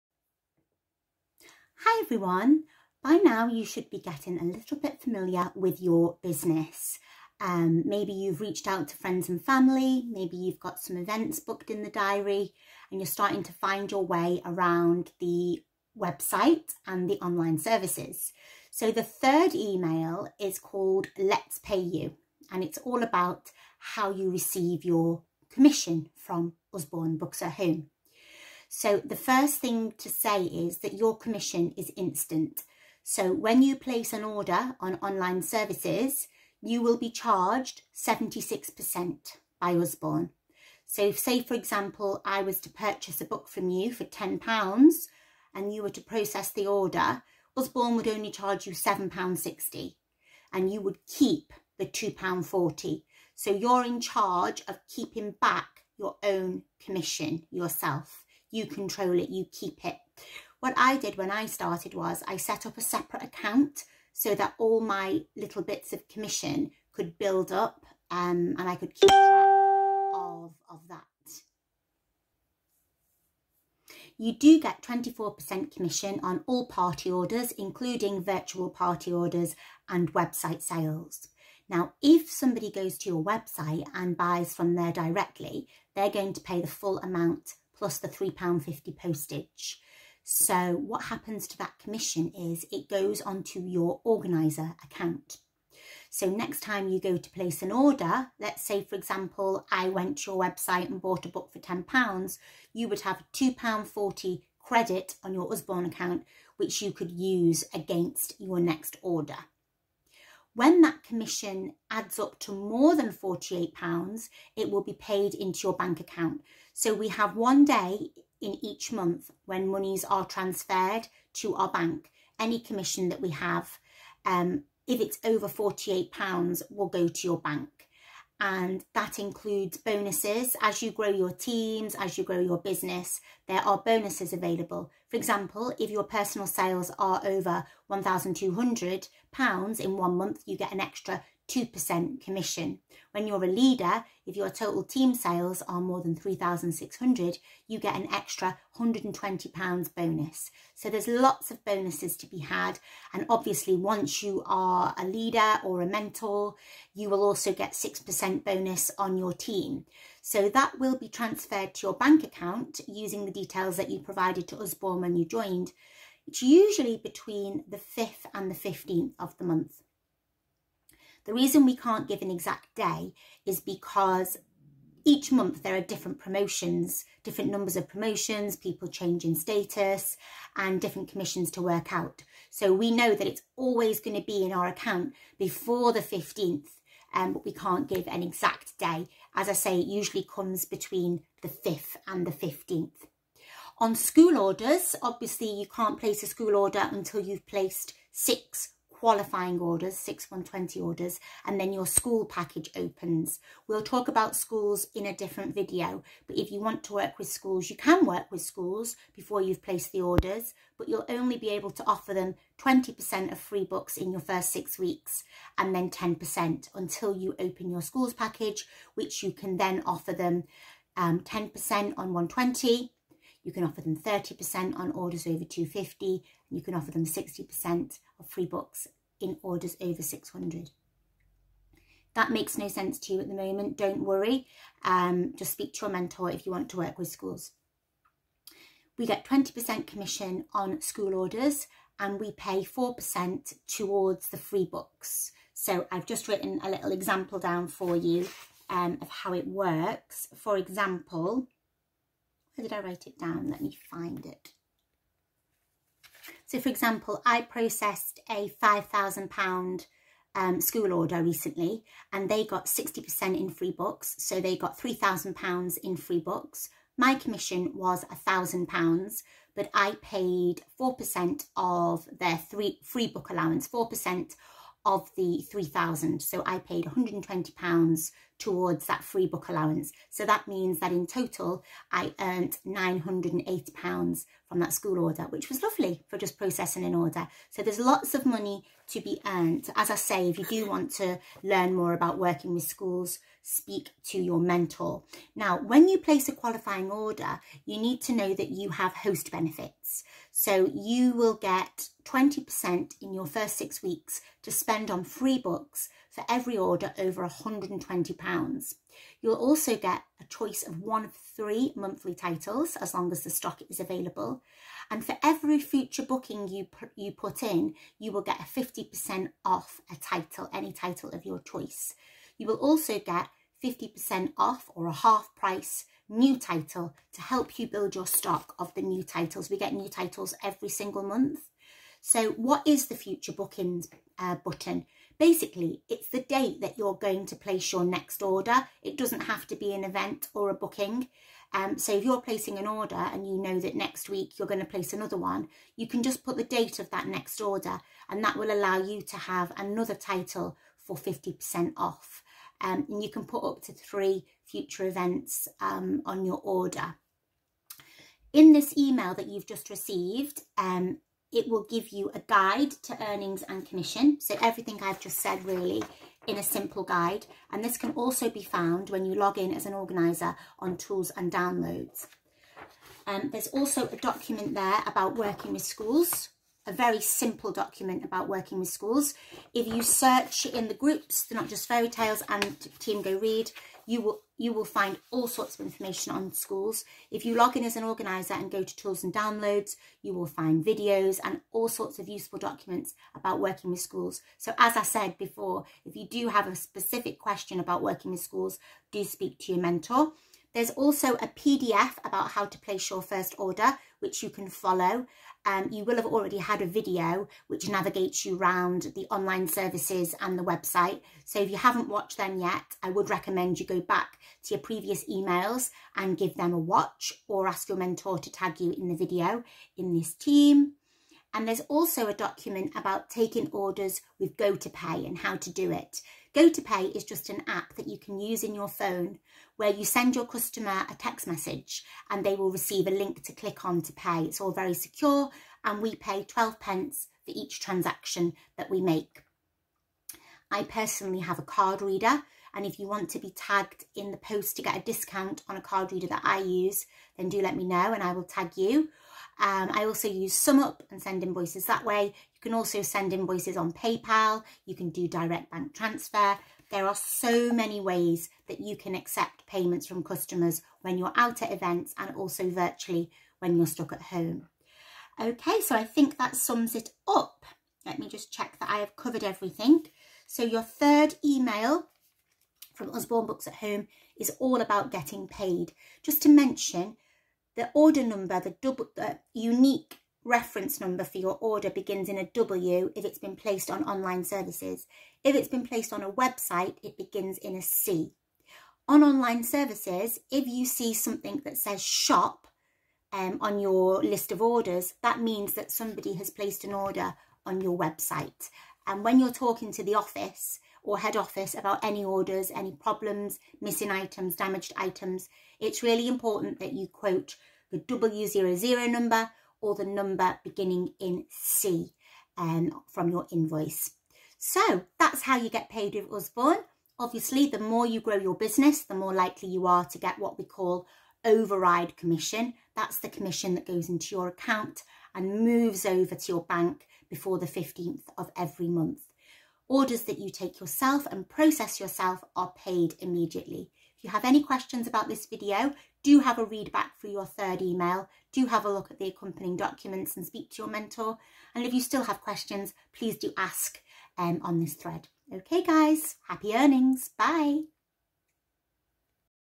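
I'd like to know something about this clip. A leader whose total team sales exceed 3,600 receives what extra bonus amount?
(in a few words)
£120 bonus.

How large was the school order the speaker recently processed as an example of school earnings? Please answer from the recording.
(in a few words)
£5,000.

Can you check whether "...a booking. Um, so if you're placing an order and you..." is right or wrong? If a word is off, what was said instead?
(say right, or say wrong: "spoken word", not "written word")
right.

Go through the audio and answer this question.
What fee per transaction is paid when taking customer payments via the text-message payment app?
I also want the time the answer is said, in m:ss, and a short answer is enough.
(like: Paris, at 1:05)
12 pence, at 7:16.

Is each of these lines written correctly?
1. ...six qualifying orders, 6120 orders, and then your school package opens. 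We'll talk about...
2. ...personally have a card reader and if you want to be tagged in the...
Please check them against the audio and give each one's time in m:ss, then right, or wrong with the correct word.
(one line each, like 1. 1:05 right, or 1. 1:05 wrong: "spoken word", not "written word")
1. 3:18 right
2. 7:20 right.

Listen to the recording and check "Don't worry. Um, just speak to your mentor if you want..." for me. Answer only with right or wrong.
right.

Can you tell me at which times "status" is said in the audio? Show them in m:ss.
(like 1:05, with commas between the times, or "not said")
2:59.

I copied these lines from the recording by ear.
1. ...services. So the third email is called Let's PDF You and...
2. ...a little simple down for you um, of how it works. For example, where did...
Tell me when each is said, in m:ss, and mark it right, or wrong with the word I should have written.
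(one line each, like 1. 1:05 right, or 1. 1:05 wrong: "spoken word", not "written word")
1. 0:17 wrong: "Pay", not "PDF"
2. 4:06 wrong: "example", not "simple".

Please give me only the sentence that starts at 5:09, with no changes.
You'll also get a choice of one of three monthly titles as long as the stock is available.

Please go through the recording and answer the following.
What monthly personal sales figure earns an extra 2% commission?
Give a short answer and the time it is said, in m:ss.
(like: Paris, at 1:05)
£1,200, at 2:17.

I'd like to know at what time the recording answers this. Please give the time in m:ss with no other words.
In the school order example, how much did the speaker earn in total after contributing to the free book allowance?
4:42.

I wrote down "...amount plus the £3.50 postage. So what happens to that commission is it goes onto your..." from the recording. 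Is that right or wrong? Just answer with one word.
right.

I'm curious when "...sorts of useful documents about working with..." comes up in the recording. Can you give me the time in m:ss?
6:31.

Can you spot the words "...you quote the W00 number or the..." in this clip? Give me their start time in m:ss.
8:26.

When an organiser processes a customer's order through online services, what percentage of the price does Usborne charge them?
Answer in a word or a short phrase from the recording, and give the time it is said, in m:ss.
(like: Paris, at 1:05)
76%, at 0:37.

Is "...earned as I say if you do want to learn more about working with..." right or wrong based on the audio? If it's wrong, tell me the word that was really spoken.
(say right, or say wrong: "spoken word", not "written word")
right.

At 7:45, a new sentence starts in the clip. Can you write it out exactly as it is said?
Okay, so I think that sums it up.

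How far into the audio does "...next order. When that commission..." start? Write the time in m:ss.
1:48.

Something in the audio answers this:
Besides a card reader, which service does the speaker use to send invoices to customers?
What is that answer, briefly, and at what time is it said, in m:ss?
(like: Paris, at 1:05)
SumUp, at 7:30.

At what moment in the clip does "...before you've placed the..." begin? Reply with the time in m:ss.
3:29.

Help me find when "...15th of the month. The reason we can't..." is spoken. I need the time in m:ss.
2:48.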